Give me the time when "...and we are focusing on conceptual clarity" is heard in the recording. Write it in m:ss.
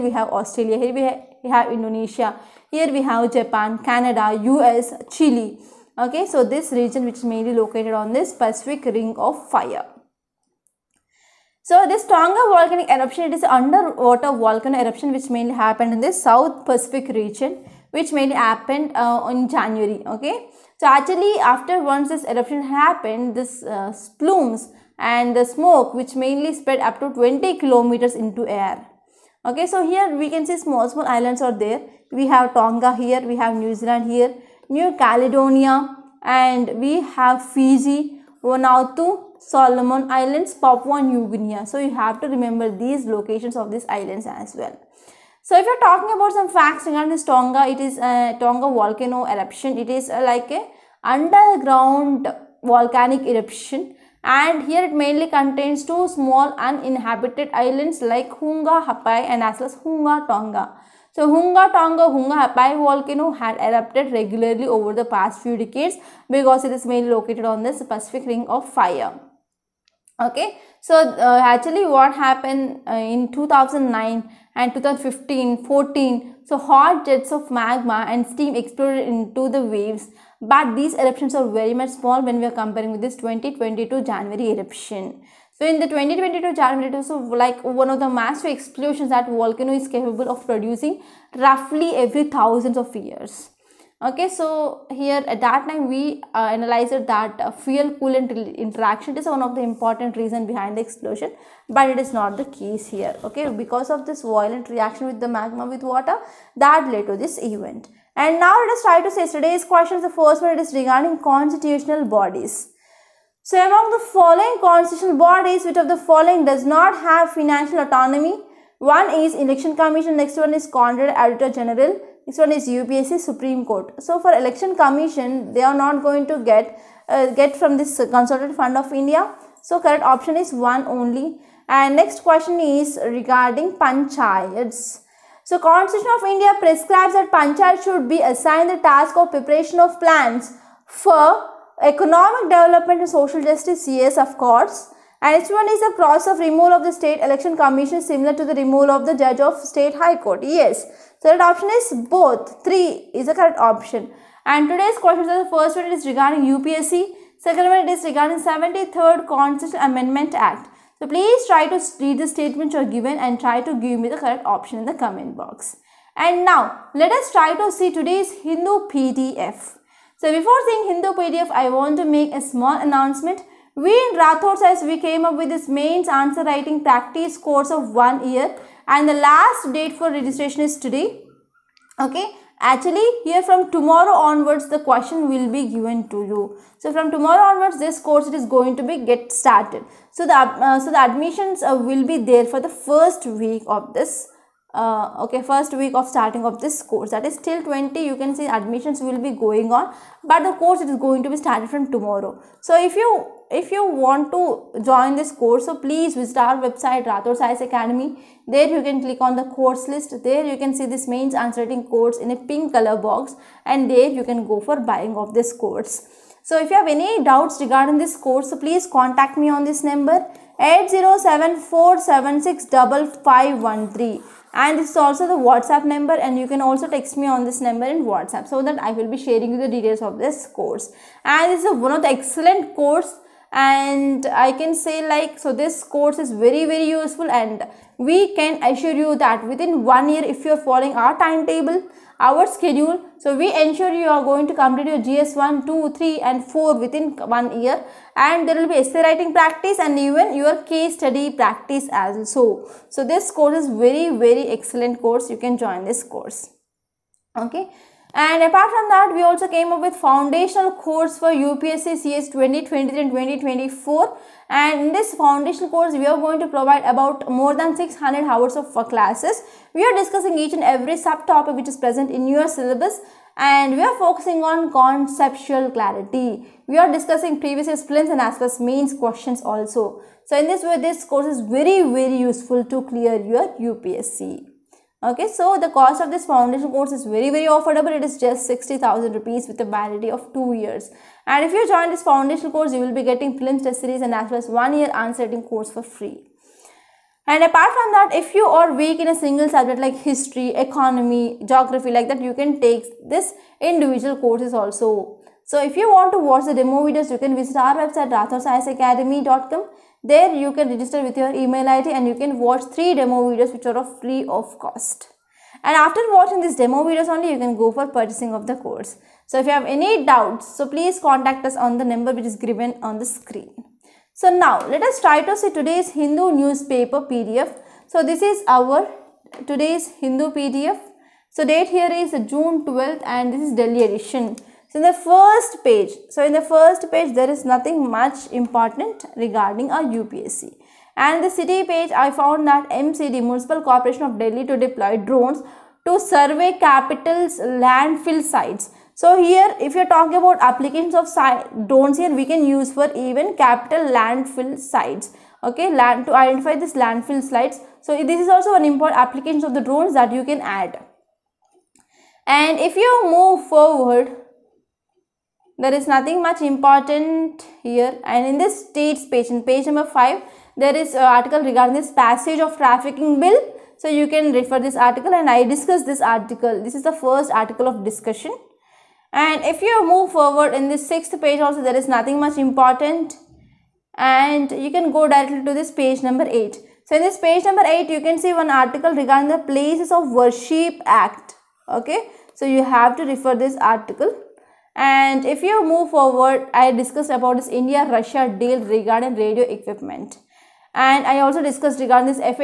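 4:33.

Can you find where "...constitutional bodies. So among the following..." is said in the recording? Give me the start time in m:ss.
1:51.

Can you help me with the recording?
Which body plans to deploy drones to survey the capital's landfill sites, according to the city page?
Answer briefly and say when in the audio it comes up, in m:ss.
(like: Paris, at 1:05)
Municipal Corporation of Delhi, at 5:43.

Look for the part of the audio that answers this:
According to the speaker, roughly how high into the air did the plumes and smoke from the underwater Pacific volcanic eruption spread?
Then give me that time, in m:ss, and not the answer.
0:27.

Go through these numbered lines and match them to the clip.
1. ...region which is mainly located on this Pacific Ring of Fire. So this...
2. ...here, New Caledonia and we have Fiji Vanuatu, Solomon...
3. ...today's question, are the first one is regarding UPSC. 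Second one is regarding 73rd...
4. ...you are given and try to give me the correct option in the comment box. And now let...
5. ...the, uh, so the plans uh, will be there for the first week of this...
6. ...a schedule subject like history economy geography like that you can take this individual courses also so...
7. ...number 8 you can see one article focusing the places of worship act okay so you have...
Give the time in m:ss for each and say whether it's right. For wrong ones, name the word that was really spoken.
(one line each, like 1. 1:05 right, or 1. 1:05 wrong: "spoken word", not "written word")
1. 0:06 right
2. 0:34 right
3. 2:34 right
4. 2:42 right
5. 3:10 wrong: "admissions", not "plans"
6. 4:59 wrong: "single", not "schedule"
7. 6:27 wrong: "regarding", not "focusing".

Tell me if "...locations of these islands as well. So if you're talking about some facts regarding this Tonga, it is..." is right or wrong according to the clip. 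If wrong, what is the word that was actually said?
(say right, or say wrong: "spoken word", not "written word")
right.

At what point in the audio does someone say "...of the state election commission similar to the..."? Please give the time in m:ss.
2:26.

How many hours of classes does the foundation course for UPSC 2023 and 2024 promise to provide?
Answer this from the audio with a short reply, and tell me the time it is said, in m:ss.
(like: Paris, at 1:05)
More than 600, at 4:27.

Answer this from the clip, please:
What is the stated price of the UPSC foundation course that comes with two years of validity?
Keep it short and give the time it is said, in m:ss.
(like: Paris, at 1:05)
60000 rupees, at 4:48.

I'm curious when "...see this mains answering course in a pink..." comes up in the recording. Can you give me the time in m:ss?
3:30.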